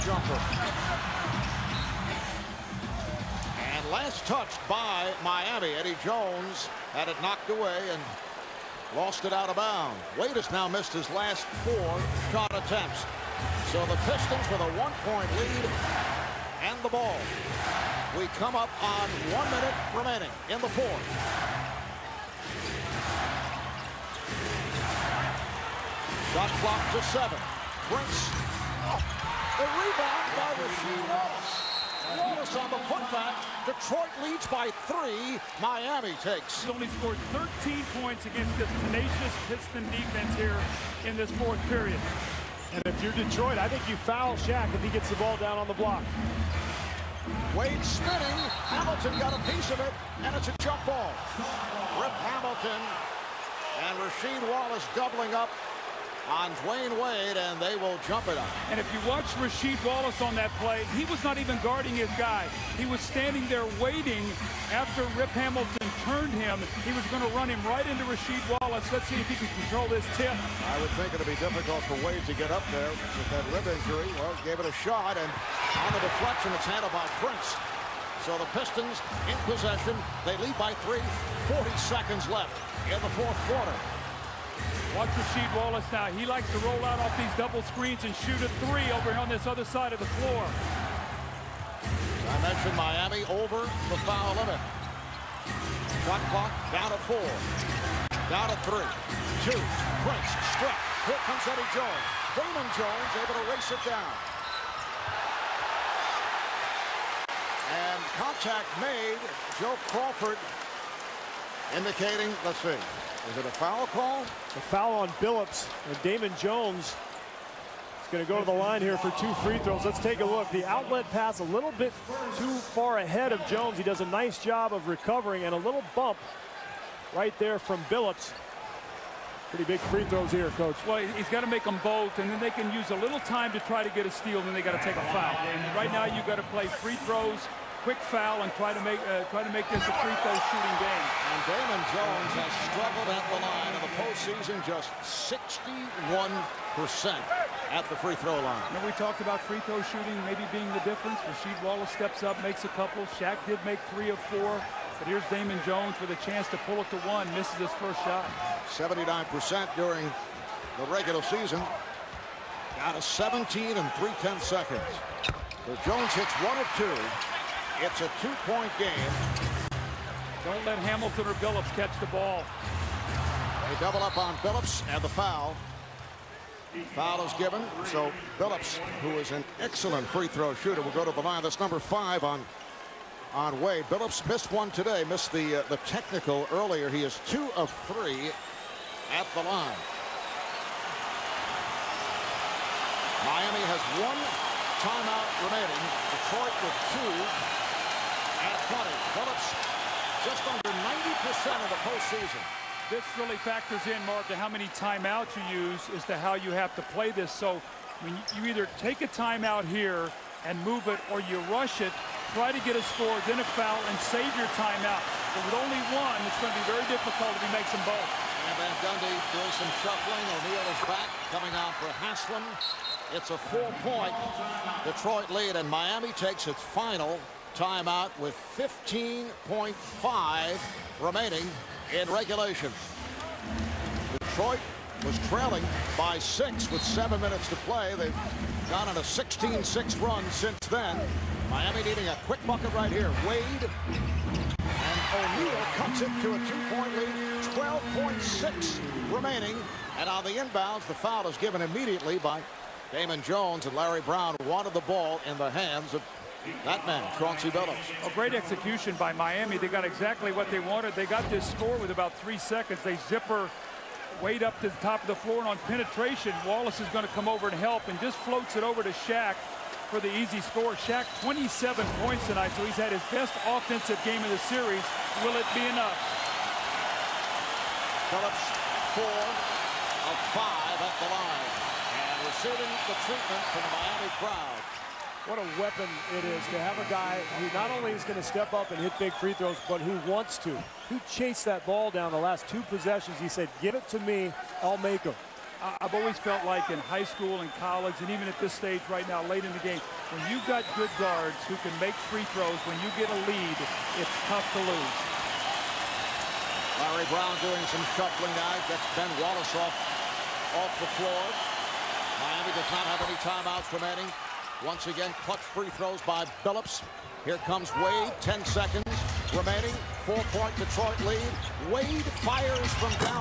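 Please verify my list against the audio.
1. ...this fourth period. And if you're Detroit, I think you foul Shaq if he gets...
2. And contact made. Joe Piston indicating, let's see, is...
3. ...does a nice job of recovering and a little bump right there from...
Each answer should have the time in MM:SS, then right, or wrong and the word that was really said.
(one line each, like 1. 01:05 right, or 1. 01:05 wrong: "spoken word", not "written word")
1. 00:41 right
2. 01:47 wrong: "Crawford", not "Piston"
3. 02:03 right.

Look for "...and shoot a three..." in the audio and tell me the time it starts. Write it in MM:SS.
01:28.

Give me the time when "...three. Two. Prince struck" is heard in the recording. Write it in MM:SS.
01:38.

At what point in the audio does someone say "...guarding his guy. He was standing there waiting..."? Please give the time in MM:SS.
01:01.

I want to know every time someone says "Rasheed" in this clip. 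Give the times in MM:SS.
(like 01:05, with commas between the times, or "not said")
00:30, 00:53, 00:59, 01:08, 01:25, 02:31.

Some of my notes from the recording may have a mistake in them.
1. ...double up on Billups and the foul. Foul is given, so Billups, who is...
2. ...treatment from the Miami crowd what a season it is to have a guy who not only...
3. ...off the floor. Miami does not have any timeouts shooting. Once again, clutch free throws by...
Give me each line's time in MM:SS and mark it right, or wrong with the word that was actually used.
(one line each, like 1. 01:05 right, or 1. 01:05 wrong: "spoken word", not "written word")
1. 02:53 right
2. 04:43 wrong: "weapon", not "season"
3. 05:10 wrong: "remaining", not "shooting".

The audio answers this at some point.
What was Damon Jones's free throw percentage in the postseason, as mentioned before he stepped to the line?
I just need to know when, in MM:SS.
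02:25.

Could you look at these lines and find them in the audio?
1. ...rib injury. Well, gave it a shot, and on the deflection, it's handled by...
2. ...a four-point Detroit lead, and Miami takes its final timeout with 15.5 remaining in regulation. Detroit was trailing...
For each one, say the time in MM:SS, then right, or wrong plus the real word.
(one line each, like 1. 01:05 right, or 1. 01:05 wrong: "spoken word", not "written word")
1. 01:13 right
2. 03:43 right.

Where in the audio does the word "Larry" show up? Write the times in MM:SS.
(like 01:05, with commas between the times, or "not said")
04:13, 05:06.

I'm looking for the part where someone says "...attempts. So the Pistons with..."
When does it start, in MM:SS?
00:12.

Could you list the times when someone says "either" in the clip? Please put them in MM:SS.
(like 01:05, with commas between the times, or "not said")
03:28.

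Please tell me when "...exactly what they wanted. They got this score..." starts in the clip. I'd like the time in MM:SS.
04:19.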